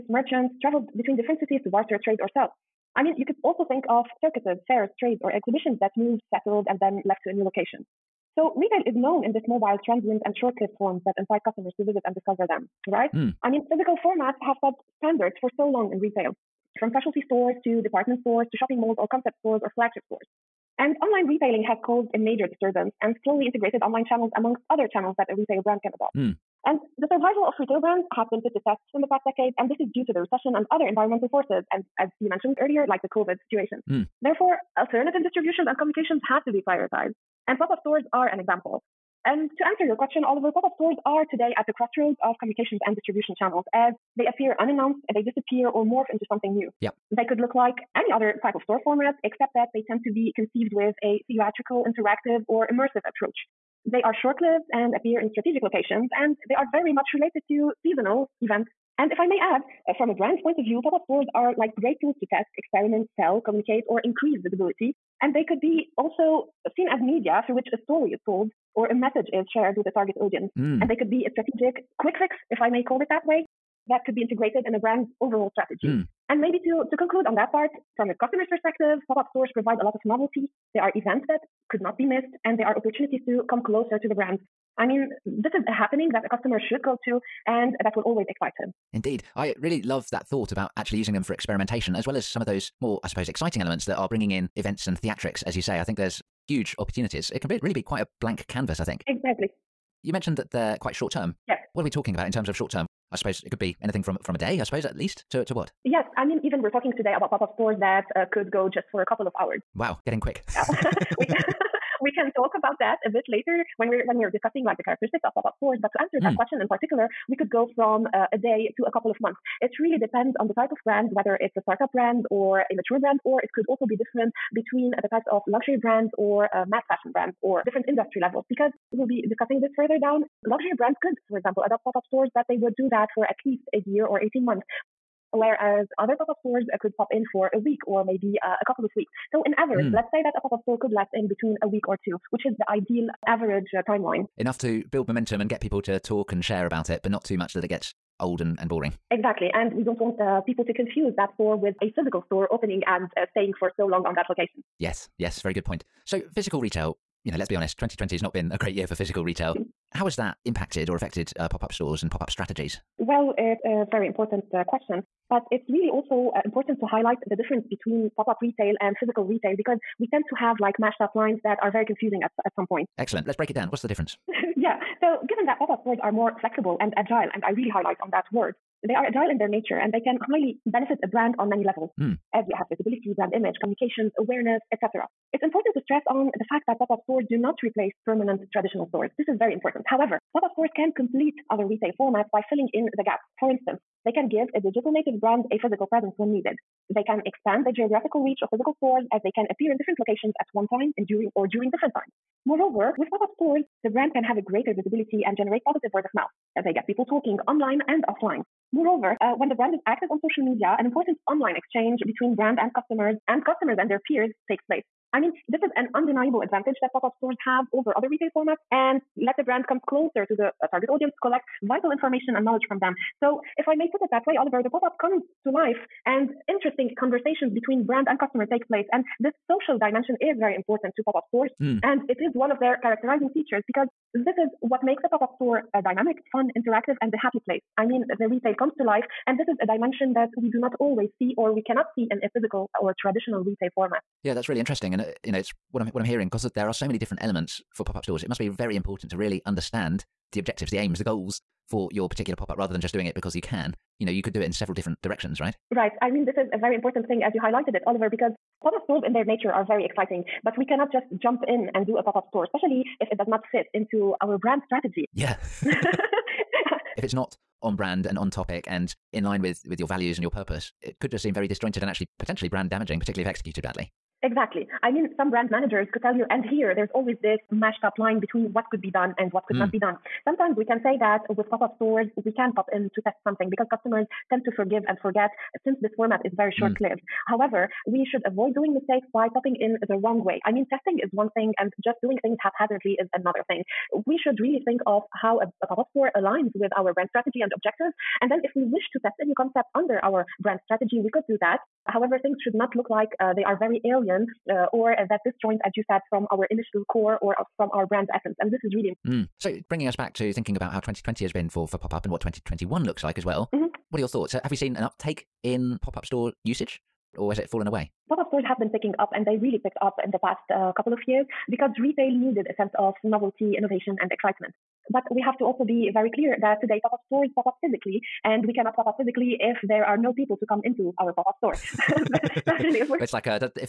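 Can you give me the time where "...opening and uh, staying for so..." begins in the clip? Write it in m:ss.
2:32.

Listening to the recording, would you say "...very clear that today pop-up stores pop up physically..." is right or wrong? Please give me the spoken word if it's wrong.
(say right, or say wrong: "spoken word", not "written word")
right.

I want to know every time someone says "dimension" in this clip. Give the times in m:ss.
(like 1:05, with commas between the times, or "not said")
3:49, 3:59.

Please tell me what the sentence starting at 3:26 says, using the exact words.
They get people talking online and offline.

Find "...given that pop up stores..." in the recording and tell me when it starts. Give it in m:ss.
2:55.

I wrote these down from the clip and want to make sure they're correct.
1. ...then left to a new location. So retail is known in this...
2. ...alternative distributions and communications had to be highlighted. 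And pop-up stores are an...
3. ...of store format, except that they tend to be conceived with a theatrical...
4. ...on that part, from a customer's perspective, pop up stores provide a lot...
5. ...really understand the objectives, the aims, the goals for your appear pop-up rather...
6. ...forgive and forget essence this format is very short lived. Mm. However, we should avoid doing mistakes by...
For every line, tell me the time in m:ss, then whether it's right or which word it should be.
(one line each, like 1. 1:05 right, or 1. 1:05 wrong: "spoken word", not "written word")
1. 0:06 right
2. 0:34 wrong: "prioritized", not "highlighted"
3. 0:48 right
4. 1:17 right
5. 4:09 wrong: "particular", not "appear"
6. 4:44 wrong: "since", not "essence".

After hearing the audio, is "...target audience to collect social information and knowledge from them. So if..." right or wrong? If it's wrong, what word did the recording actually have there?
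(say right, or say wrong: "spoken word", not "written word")
wrong: "vital", not "social".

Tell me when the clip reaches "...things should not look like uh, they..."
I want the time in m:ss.
5:02.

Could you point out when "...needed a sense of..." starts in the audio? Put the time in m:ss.
5:22.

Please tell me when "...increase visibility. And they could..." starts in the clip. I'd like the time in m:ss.
1:04.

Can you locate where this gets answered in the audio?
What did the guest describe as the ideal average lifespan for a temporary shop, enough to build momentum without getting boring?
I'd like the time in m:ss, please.
2:21.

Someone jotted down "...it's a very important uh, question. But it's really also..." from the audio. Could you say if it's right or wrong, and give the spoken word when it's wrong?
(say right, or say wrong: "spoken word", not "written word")
right.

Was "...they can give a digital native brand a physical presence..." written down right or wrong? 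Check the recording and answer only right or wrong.
right.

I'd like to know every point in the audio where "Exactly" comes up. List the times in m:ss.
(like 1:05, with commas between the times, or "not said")
1:39, 2:29, 4:34.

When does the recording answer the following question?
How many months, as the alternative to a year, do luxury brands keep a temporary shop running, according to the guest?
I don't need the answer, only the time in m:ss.
2:14.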